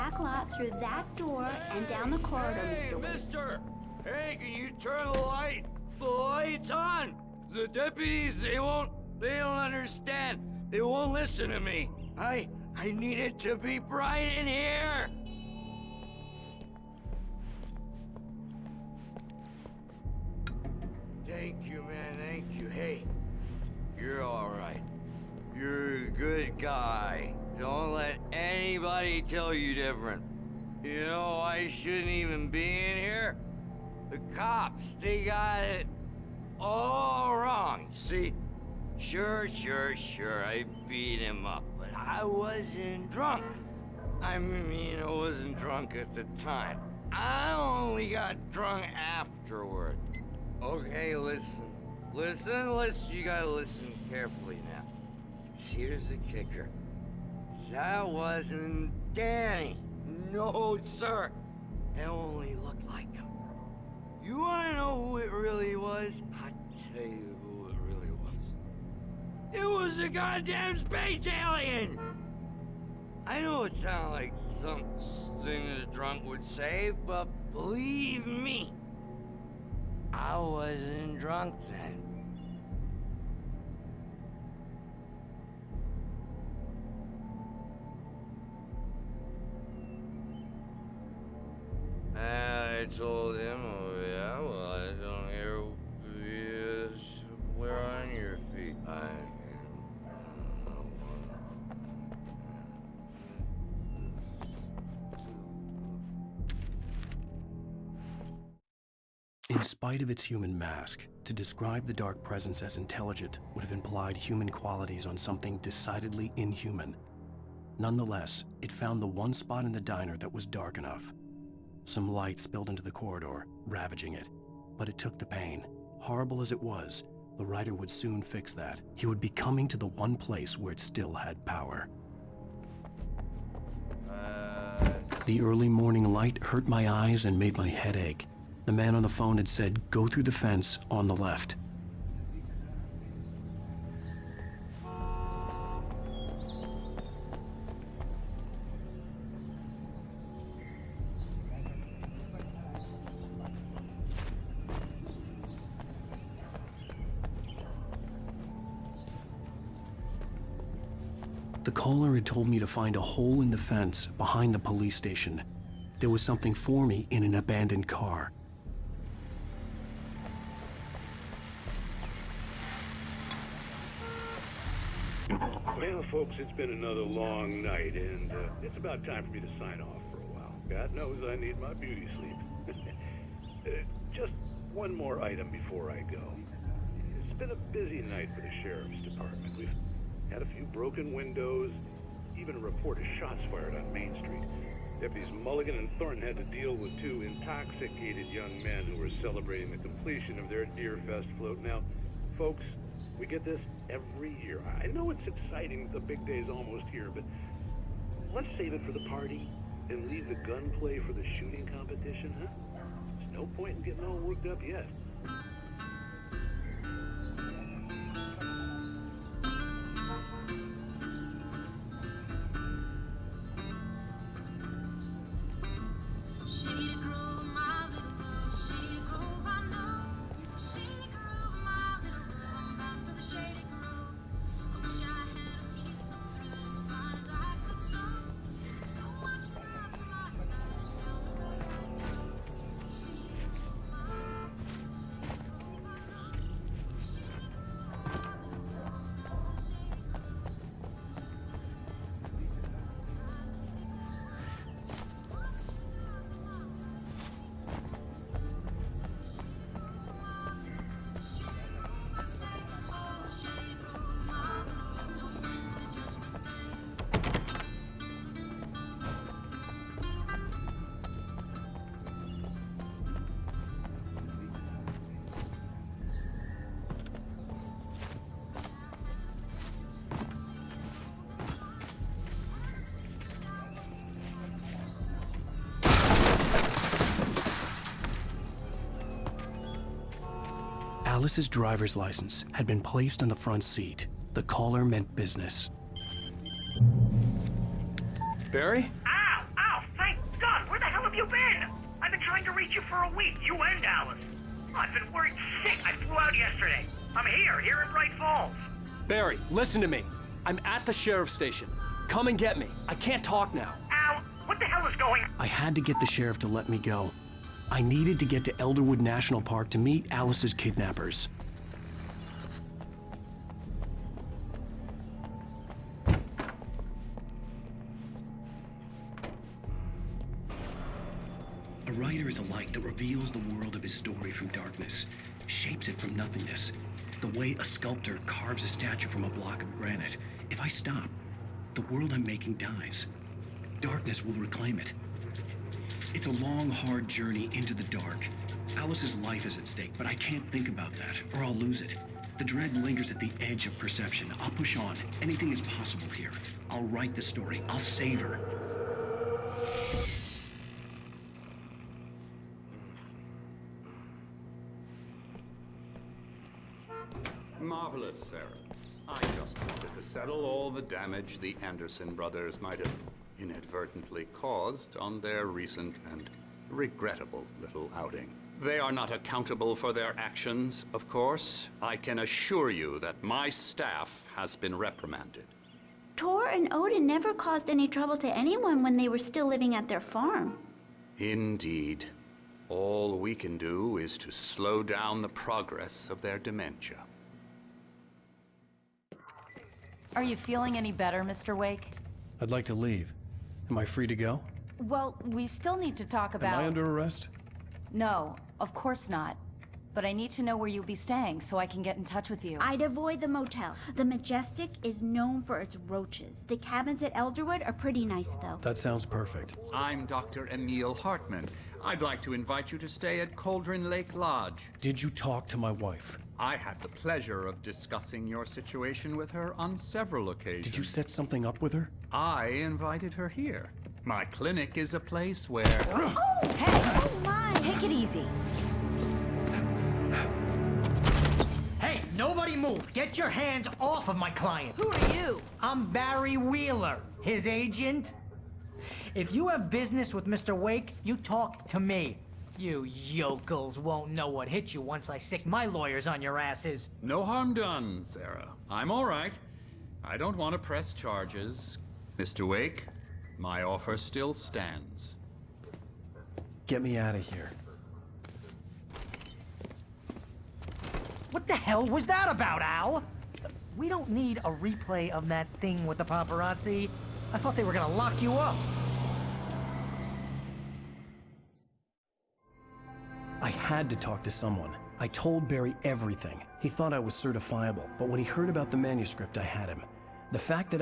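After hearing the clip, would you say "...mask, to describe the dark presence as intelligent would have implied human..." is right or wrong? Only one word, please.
right.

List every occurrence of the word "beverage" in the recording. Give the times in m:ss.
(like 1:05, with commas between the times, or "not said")
not said.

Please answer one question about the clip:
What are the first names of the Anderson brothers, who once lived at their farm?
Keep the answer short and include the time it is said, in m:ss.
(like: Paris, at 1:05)
Tor and Odin, at 6:26.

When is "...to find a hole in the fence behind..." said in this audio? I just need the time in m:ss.
2:42.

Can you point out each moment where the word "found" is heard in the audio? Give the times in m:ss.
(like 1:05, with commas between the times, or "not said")
1:58.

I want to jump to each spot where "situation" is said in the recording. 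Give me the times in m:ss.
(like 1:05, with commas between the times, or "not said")
7:08.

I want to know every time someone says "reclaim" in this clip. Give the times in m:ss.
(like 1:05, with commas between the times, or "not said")
5:44.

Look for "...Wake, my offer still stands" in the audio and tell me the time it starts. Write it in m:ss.
7:42.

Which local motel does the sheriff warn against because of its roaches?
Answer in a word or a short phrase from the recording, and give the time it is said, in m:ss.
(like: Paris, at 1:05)
The Majestic, at 6:53.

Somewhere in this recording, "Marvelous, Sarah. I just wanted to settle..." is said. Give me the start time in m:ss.
6:07.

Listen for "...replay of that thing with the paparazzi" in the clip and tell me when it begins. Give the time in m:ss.
7:54.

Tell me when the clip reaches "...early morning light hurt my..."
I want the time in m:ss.
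2:15.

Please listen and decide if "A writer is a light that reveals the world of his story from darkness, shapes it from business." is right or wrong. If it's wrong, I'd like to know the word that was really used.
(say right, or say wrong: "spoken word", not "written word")
wrong: "nothingness", not "business".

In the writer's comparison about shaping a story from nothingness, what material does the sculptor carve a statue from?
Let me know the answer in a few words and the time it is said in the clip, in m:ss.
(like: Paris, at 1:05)
granite, at 5:39.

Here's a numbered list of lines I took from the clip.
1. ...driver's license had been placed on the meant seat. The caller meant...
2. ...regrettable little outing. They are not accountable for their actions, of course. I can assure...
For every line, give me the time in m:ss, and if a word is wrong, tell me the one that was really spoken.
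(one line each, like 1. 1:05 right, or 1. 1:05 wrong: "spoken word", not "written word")
1. 4:51 wrong: "front", not "meant"
2. 6:16 right.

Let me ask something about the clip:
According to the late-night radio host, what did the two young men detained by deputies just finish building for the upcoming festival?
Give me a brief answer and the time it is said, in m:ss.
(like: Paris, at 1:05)
Deerfest float, at 3:20.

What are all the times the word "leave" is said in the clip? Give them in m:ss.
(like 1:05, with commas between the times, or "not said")
3:30, 6:42.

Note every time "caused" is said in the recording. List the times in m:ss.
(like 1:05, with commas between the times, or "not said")
6:14, 6:27.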